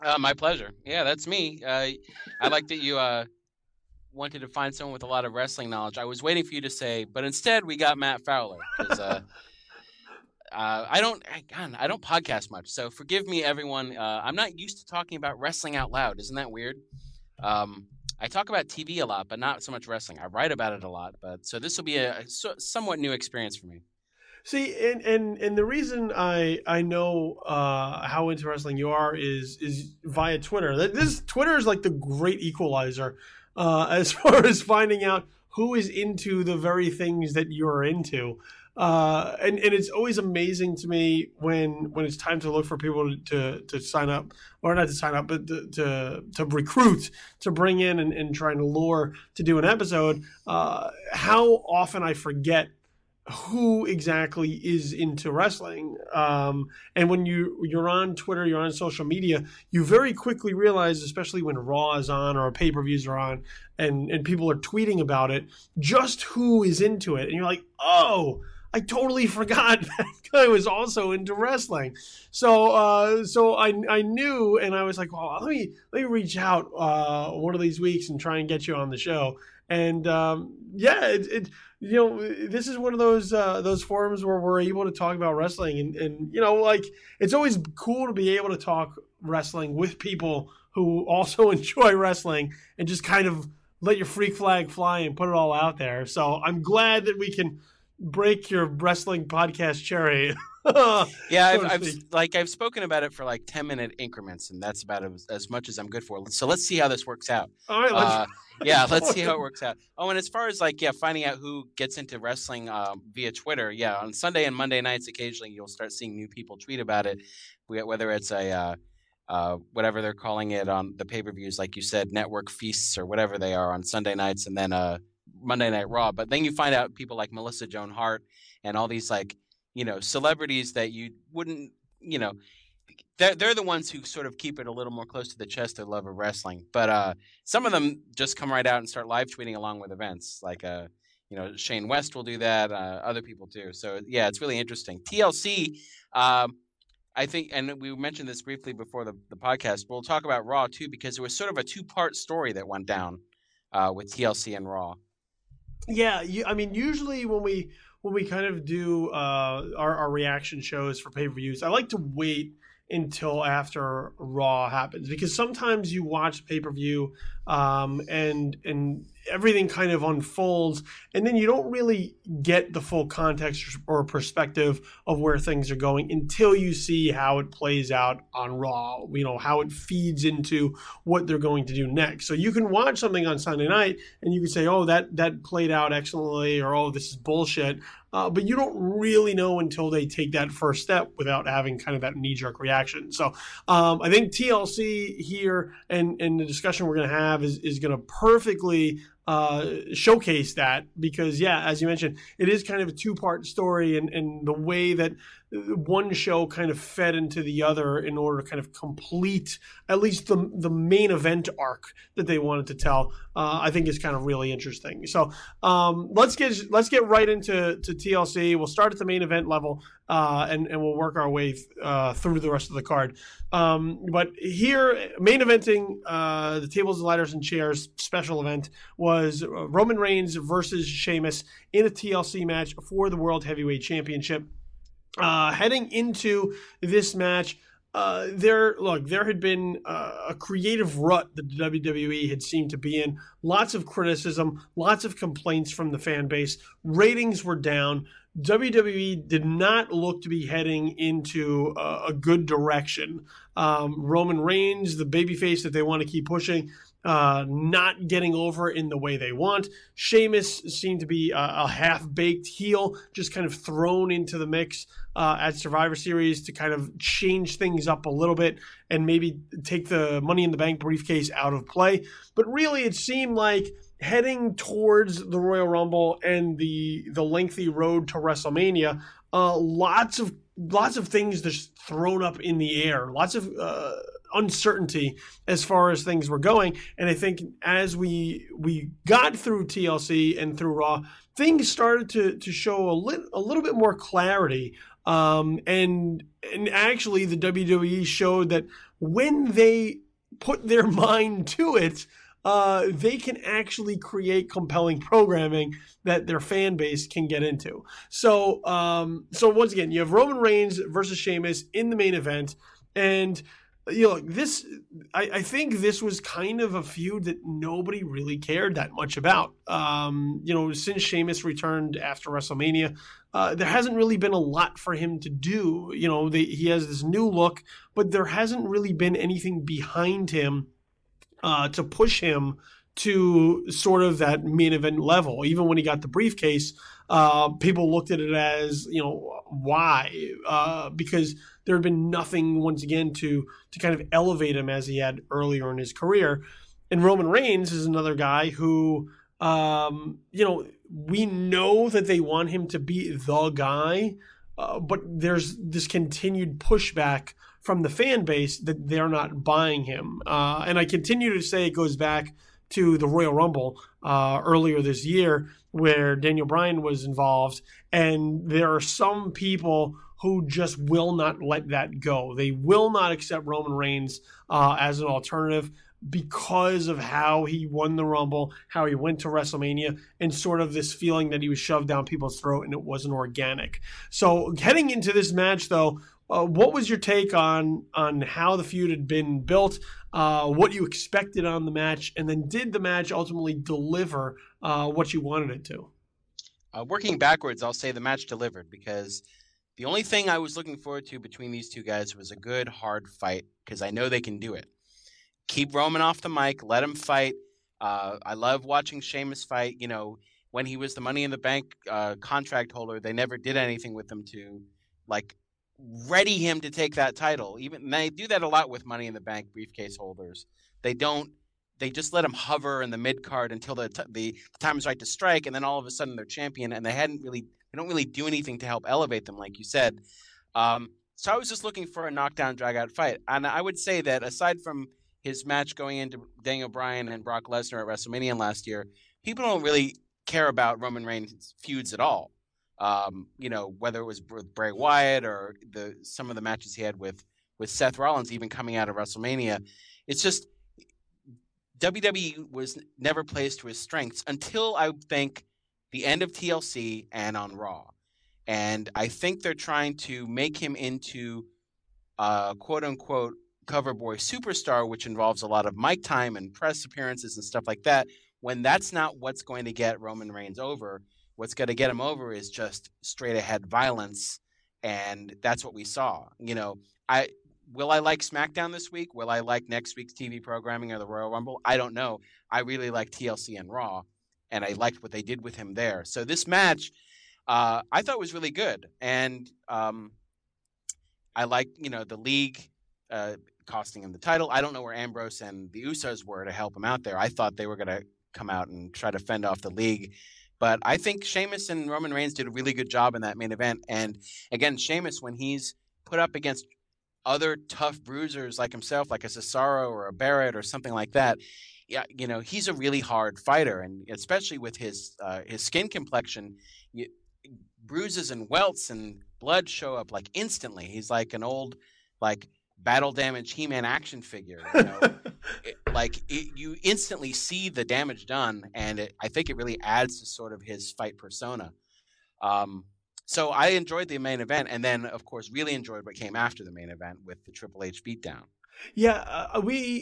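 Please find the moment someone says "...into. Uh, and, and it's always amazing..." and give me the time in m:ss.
0:37.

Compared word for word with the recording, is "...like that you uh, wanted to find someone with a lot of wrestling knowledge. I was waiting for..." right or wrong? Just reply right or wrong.
right.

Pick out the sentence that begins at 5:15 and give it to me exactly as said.
I, I think this was kind of a feud that nobody really cared that much about.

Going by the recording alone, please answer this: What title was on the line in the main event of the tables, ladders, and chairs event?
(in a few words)
World Heavyweight Championship.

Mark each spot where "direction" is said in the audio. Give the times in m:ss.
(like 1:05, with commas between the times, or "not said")
4:12.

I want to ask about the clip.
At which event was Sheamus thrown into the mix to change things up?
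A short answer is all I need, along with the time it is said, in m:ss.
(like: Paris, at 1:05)
Survivor Series, at 4:25.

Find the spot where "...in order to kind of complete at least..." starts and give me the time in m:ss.
3:27.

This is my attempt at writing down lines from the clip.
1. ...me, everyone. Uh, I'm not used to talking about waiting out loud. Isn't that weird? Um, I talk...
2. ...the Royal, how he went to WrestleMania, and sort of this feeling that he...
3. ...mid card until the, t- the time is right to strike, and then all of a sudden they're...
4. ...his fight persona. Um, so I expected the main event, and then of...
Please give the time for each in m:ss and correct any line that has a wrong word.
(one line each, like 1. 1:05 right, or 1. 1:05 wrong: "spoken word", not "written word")
1. 0:13 wrong: "wrestling", not "waiting"
2. 6:17 wrong: "Rumble", not "Royal"
3. 7:02 right
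4. 8:50 wrong: "enjoyed", not "expected".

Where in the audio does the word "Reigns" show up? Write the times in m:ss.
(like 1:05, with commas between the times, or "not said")
3:49, 4:14, 5:10, 5:47, 6:13, 7:21, 7:50, 8:22.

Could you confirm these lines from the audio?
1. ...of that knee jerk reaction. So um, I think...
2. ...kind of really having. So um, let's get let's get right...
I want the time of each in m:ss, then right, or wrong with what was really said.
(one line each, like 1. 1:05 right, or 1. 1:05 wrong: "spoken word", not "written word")
1. 3:11 right
2. 3:33 wrong: "interesting", not "having".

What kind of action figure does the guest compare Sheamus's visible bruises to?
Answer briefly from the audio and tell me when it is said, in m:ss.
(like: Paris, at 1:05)
battle damage He-Man, at 8:42.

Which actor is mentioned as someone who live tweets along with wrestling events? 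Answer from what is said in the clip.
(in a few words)
Shane West.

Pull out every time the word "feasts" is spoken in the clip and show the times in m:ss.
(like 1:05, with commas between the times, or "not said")
2:02.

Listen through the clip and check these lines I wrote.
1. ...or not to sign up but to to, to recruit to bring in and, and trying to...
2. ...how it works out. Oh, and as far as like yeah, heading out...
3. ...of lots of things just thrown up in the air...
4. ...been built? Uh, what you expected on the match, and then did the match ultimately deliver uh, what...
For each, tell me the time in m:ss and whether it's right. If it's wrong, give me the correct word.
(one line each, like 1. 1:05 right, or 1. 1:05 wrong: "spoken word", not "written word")
1. 0:44 right
2. 1:49 wrong: "finding", not "heading"
3. 4:40 right
4. 6:29 right.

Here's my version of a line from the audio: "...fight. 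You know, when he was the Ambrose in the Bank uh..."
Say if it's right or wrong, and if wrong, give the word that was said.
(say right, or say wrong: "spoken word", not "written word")
wrong: "Money", not "Ambrose".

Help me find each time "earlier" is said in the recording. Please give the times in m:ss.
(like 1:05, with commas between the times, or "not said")
5:45, 6:04.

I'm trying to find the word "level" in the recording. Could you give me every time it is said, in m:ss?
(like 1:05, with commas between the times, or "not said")
3:39, 5:34.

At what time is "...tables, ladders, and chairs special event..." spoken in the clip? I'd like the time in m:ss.
3:46.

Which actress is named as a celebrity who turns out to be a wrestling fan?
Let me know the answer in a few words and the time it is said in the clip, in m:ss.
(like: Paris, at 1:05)
Melissa Joan Hart, at 2:07.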